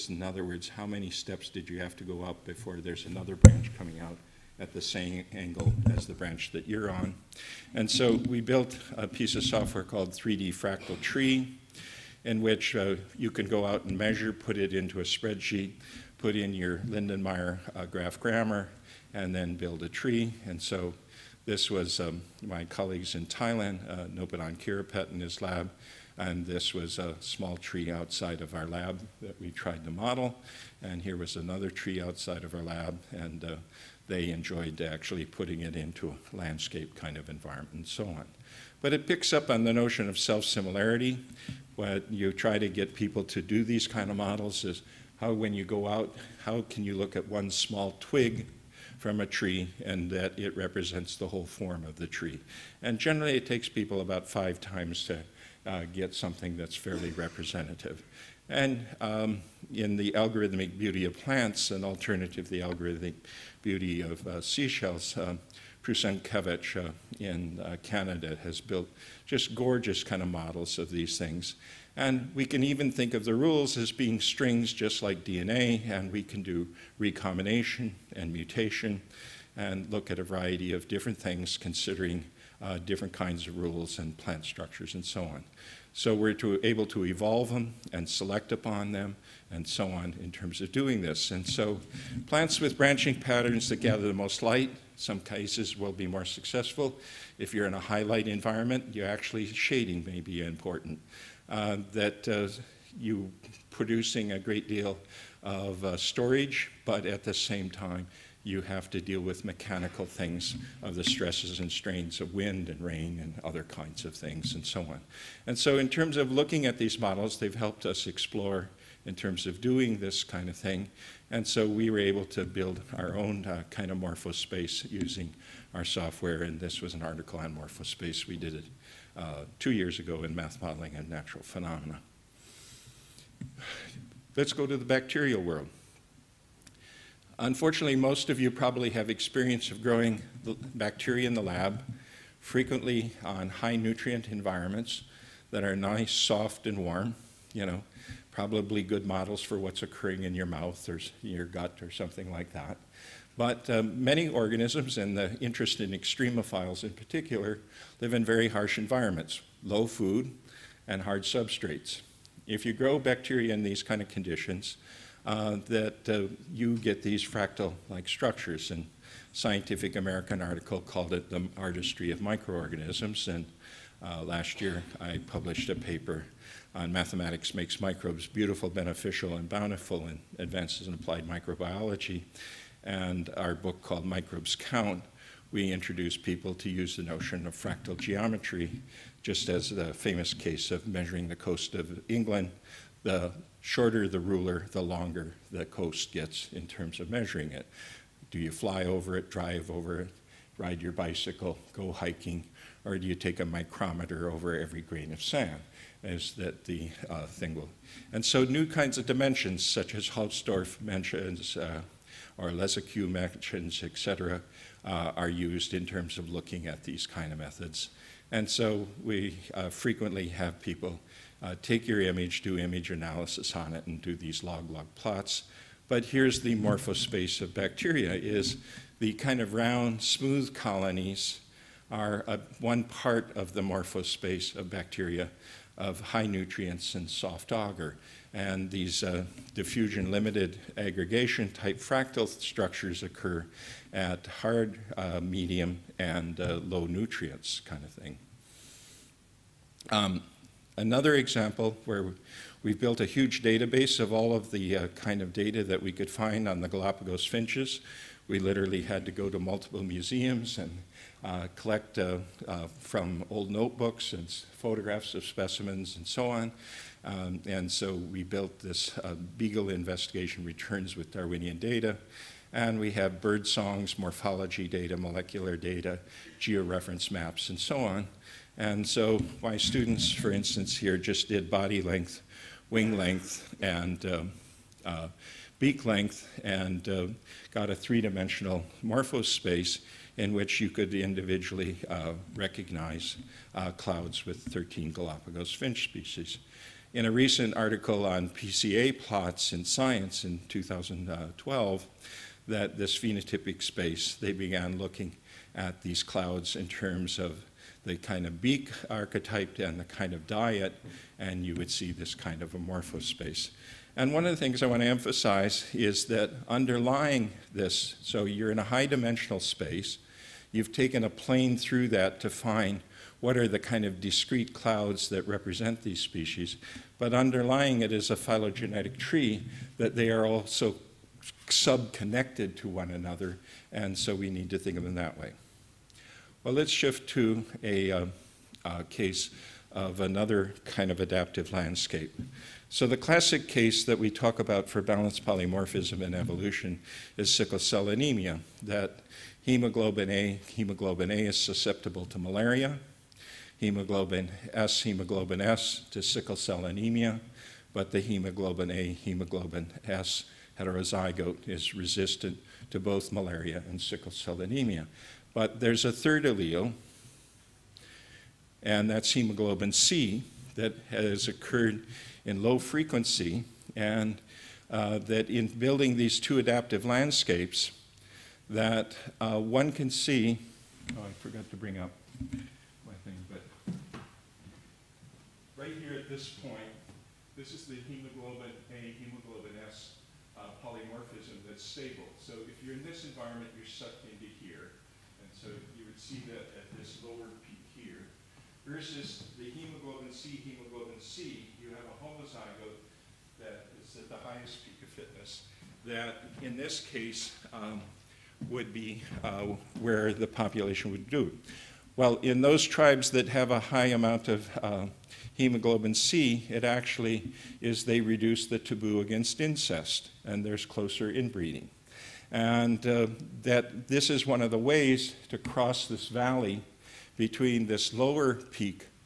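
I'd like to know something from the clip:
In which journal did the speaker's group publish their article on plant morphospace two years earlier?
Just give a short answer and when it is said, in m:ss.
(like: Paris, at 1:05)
Math Modeling and Natural Phenomena, at 2:10.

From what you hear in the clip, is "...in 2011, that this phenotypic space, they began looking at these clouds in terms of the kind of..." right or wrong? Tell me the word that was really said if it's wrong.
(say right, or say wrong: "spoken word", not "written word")
wrong: "2012", not "2011".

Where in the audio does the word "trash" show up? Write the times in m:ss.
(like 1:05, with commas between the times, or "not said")
not said.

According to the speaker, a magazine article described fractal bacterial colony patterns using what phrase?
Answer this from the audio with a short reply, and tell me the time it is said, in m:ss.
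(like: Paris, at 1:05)
the artistry of microorganisms, at 2:51.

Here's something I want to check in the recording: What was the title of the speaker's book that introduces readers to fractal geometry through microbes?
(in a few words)
Microbes Count.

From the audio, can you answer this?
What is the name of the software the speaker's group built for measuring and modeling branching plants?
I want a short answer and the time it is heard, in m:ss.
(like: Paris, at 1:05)
3D Fractal Tree, at 0:10.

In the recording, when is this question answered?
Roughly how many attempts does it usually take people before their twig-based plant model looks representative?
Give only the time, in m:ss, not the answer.
0:54.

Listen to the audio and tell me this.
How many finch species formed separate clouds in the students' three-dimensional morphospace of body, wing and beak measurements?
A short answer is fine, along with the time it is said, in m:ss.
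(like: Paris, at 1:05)
13, at 4:54.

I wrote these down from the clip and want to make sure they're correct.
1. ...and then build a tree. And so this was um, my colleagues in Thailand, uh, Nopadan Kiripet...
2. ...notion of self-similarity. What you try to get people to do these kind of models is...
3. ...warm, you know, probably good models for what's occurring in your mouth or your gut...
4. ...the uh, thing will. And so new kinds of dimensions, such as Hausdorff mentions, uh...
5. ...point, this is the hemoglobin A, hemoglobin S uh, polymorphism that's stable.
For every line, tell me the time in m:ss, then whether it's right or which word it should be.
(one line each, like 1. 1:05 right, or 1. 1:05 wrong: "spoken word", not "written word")
1. 0:19 right
2. 0:39 right
3. 2:26 right
4. 3:26 right
5. 6:26 right.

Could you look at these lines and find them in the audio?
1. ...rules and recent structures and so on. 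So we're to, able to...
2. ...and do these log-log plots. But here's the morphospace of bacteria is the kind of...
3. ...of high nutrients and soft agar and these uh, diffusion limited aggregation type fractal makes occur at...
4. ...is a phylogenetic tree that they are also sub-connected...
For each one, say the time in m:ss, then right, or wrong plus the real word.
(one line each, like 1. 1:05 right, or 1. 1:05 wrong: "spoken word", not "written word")
1. 1:23 wrong: "plant", not "recent"
2. 3:43 right
3. 3:55 wrong: "structures", not "makes"
4. 5:27 right.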